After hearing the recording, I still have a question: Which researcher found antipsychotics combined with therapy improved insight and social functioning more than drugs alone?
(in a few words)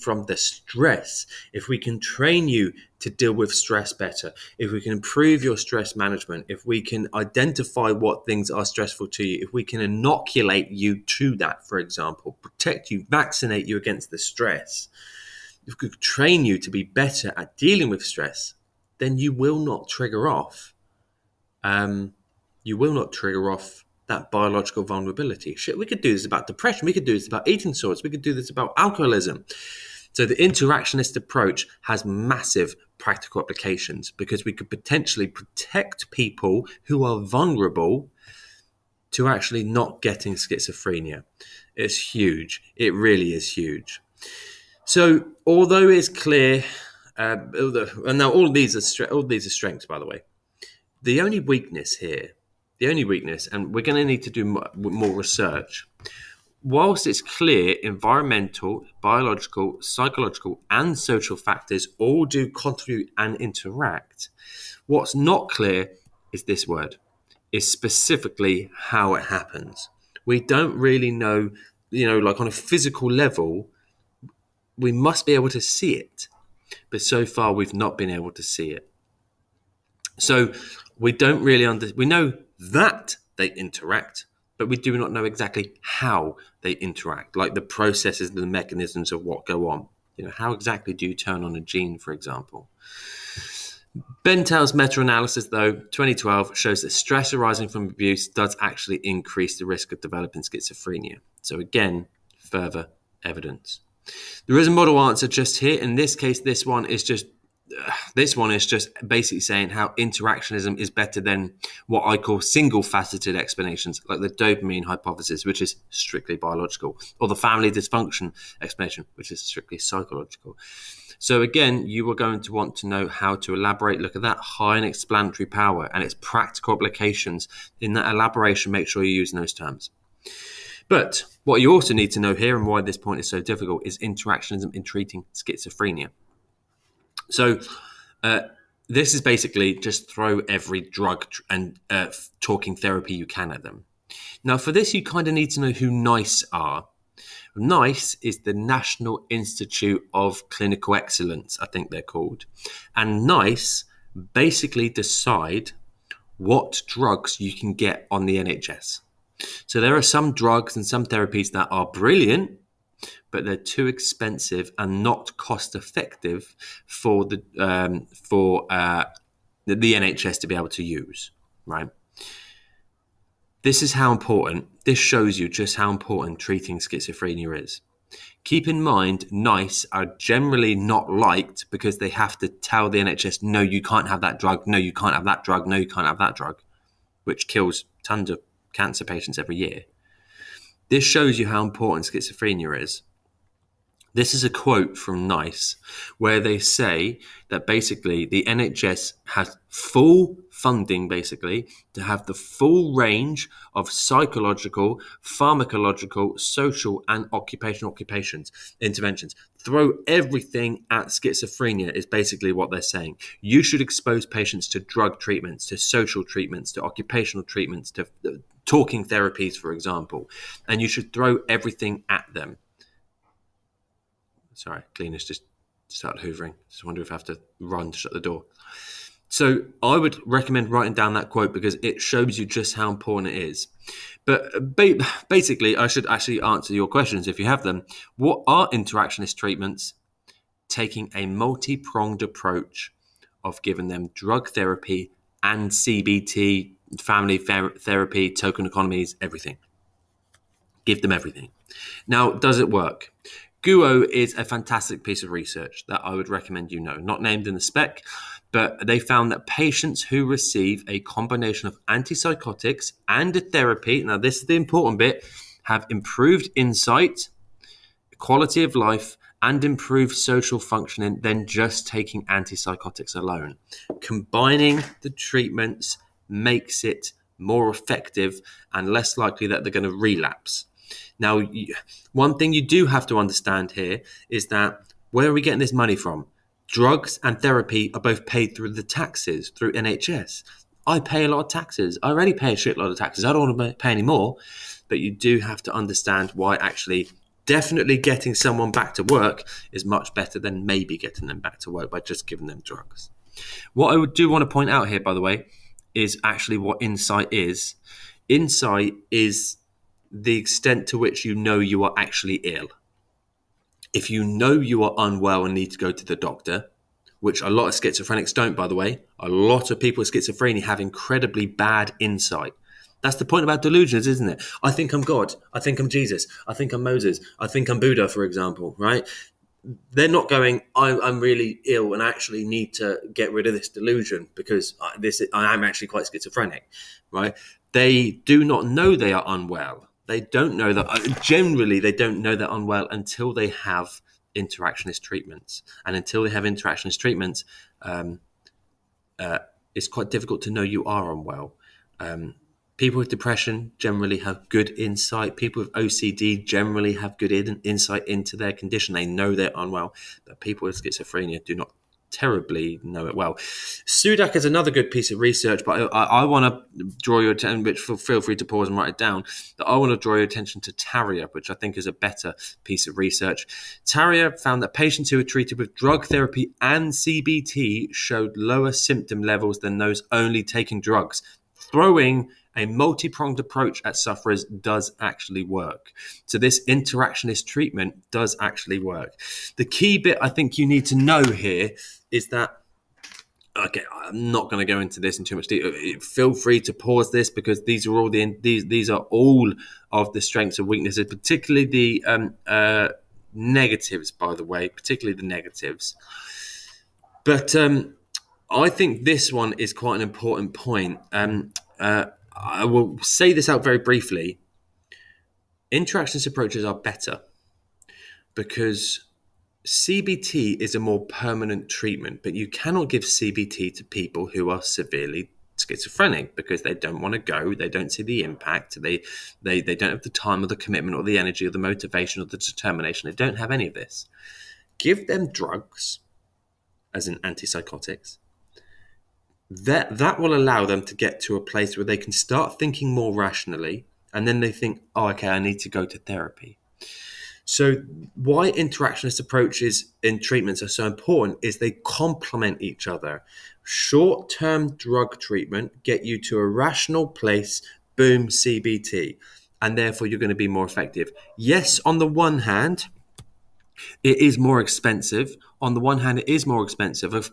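Guo.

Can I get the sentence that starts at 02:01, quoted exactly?
So, again, you are going to want to know how to elaborate.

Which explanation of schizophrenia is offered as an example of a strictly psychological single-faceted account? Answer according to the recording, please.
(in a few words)
family dysfunction explanation.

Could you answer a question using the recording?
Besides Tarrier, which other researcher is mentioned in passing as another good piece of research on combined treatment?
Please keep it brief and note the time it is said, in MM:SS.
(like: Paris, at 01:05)
Sudak, at 06:03.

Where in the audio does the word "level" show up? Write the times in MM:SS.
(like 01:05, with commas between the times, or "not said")
01:13, 06:19.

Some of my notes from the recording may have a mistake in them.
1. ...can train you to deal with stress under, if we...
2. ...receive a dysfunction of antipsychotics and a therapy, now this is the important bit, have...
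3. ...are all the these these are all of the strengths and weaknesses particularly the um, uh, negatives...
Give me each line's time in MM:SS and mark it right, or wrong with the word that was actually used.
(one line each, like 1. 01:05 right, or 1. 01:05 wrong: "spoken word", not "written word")
1. 00:01 wrong: "better", not "under"
2. 04:20 wrong: "combination", not "dysfunction"
3. 06:37 right.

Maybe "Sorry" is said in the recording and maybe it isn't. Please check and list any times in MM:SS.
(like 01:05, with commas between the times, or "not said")
03:44.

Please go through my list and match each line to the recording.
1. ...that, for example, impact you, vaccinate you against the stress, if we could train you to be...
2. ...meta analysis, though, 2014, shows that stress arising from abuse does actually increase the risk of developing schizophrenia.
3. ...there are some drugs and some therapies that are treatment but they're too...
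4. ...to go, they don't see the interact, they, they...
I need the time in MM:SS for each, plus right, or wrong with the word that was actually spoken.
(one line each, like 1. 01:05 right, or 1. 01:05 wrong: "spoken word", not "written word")
1. 00:11 wrong: "protect", not "impact"
2. 01:34 wrong: "2012", not "2014"
3. 02:39 wrong: "brilliant", not "treatment"
4. 07:07 wrong: "impact", not "interact".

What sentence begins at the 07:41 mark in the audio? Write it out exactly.
Yes, on the one hand, it is more expensive.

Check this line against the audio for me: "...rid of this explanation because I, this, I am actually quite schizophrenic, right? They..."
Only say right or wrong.
wrong.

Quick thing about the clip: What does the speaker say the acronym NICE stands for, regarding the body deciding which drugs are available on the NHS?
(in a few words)
National Institute of Clinical Excellence.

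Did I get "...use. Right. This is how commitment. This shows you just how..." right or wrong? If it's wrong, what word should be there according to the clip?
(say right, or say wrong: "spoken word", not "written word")
wrong: "important", not "commitment".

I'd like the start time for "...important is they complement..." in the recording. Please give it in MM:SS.
07:30.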